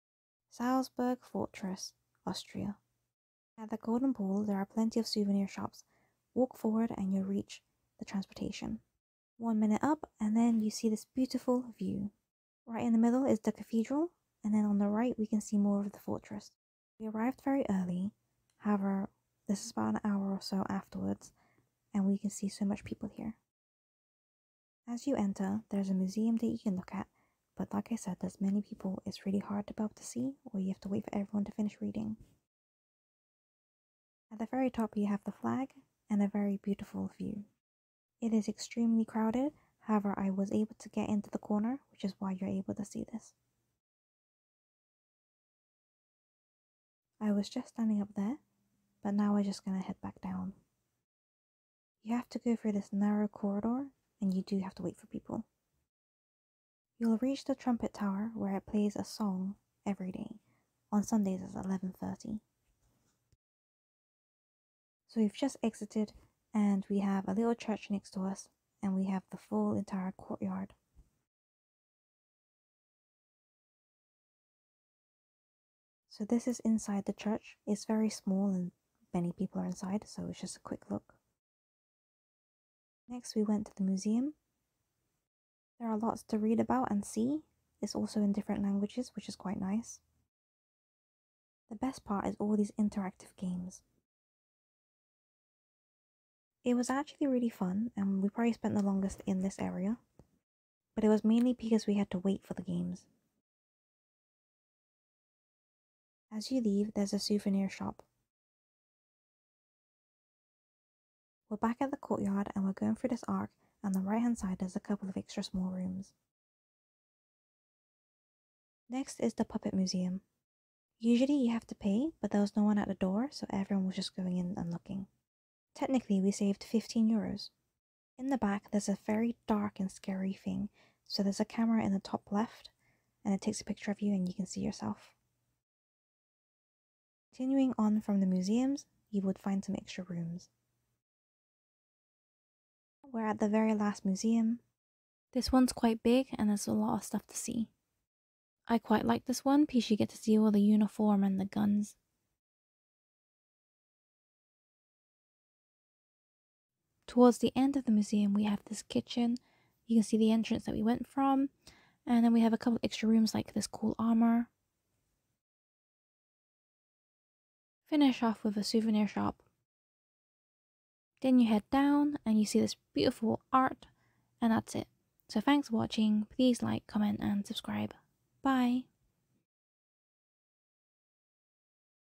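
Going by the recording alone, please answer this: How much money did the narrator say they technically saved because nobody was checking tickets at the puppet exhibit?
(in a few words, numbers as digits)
15 euros.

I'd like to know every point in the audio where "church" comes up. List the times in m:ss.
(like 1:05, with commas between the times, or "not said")
1:07, 1:17.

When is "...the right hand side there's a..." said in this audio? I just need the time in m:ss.
1:53.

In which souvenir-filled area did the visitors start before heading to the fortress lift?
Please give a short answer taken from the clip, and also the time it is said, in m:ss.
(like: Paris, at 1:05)
Golden Pool, at 0:03.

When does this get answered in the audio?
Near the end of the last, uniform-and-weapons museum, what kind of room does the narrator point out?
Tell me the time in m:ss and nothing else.
2:38.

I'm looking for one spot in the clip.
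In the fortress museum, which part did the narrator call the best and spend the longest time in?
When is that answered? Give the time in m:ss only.
1:32.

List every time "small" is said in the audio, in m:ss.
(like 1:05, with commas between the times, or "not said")
1:18, 1:55.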